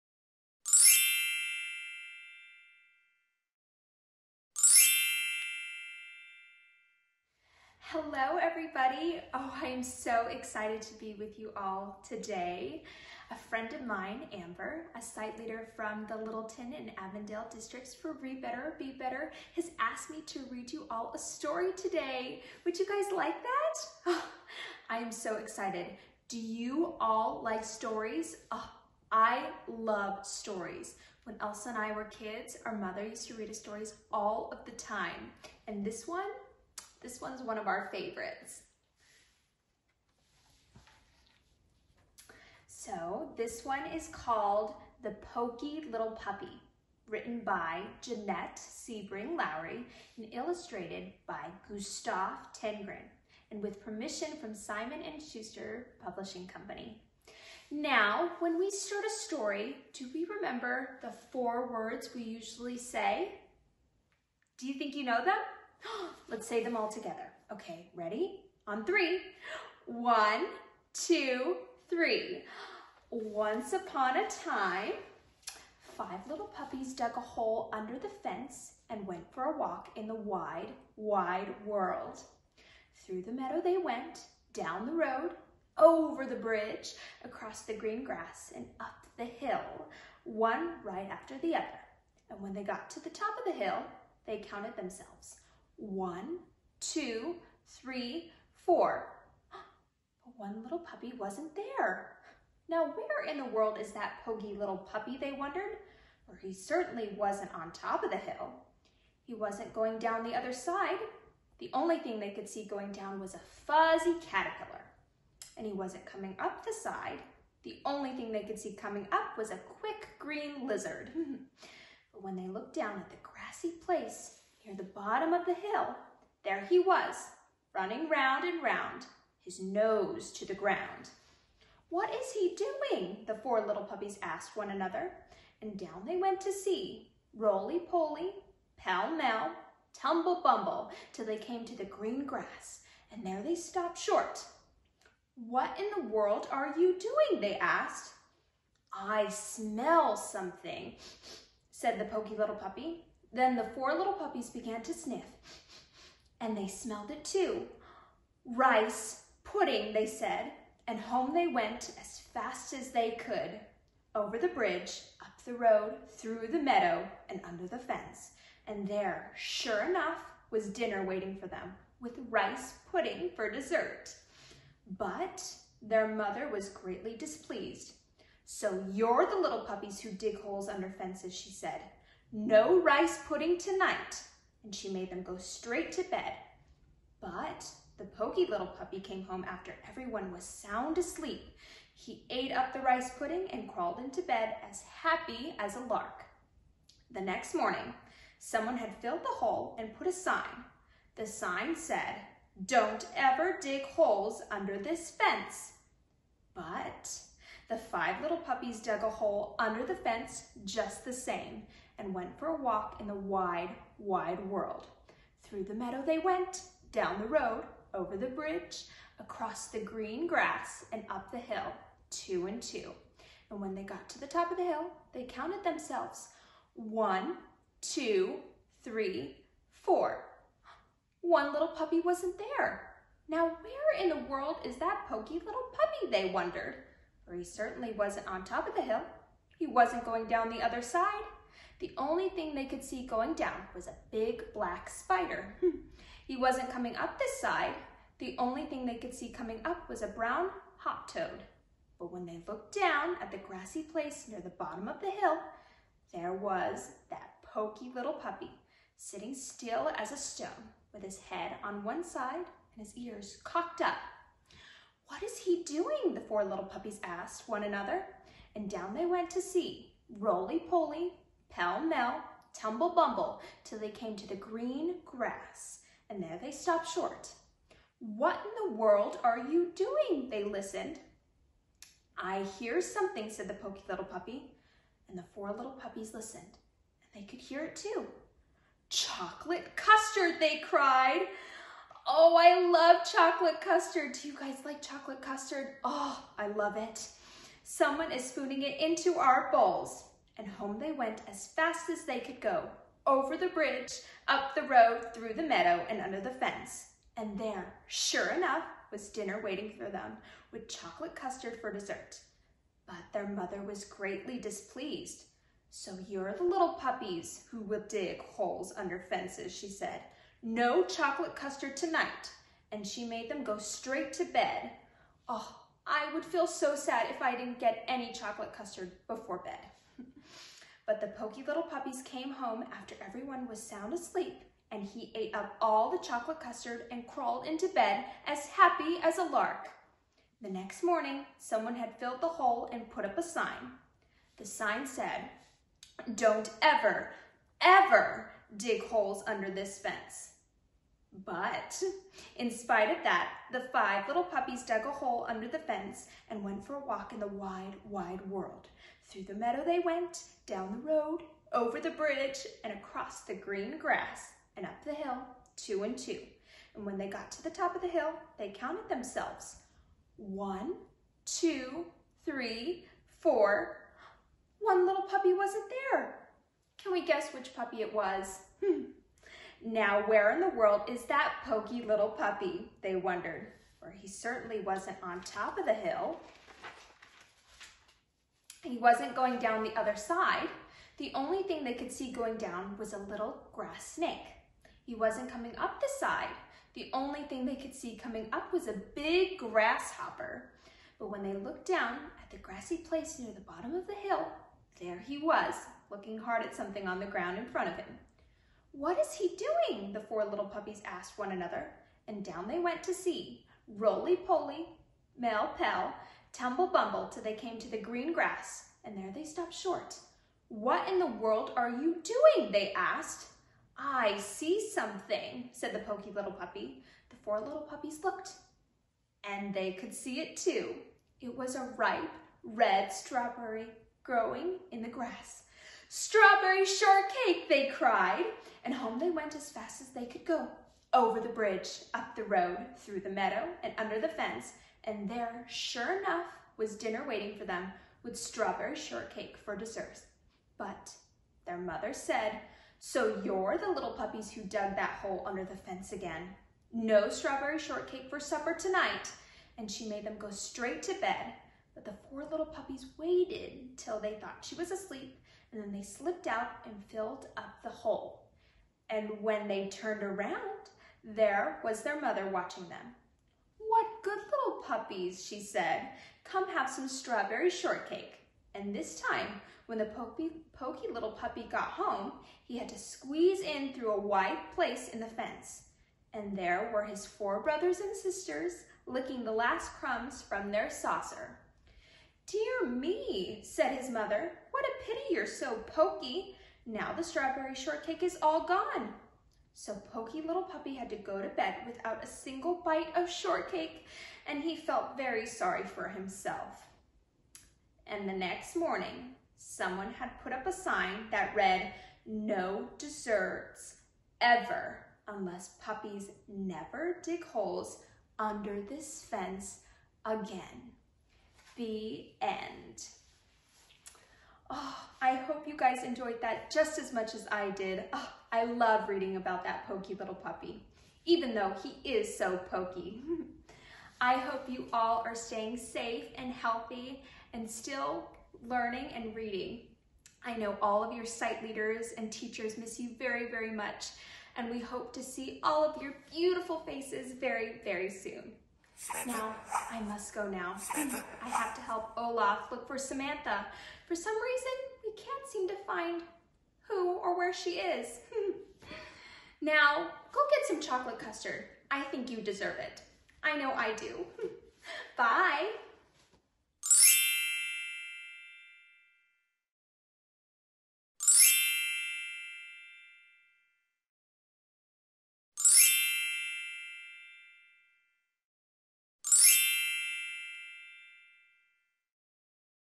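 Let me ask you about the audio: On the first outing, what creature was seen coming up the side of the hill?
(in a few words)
A quick green lizard.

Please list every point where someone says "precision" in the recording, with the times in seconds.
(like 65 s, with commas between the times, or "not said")
not said.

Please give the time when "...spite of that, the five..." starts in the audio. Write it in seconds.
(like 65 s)
352 s.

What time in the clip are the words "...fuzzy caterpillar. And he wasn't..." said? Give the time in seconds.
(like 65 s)
113 s.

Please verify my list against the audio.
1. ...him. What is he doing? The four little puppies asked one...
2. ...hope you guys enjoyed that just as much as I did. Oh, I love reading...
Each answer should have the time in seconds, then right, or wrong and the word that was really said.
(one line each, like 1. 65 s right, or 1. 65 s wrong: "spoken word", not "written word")
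1. 407 s right
2. 525 s right.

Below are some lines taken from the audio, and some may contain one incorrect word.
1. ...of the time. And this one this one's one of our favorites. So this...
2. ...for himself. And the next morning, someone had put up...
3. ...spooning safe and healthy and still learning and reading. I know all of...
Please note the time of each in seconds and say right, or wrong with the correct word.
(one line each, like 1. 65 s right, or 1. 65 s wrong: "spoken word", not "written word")
1. 34 s right
2. 505 s right
3. 535 s wrong: "staying", not "spooning".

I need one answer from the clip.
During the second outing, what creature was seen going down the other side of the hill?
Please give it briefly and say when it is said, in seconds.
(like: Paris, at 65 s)
A big black spider, at 244 s.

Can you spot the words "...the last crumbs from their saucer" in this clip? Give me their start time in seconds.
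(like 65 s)
489 s.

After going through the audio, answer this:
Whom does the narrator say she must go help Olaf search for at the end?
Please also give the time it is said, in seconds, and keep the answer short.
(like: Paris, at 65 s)
Samantha, at 552 s.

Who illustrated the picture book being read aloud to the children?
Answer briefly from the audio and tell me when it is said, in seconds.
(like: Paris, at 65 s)
Gustav Tenggren, at 51 s.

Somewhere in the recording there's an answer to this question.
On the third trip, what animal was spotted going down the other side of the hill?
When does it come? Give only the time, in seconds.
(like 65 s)
392 s.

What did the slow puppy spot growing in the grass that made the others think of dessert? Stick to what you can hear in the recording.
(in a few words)
A ripe red strawberry.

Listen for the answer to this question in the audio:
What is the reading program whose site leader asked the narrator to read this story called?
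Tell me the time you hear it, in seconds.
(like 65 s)
18 s.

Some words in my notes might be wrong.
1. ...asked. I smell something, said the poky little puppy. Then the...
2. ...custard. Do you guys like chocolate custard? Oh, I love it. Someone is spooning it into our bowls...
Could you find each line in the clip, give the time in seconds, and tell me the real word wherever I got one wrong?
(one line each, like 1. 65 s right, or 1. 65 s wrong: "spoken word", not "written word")
1. 147 s right
2. 293 s right.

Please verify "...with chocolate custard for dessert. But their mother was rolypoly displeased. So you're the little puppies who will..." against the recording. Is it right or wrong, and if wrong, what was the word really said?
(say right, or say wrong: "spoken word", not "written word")
wrong: "greatly", not "rolypoly".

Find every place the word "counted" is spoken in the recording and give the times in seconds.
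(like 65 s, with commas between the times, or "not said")
94 s, 225 s, 368 s.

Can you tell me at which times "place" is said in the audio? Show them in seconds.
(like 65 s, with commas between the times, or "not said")
123 s, 253 s, 402 s, 484 s.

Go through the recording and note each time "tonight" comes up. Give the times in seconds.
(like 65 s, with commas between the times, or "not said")
183 s, 321 s, 458 s.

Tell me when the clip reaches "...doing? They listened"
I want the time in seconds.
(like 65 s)
279 s.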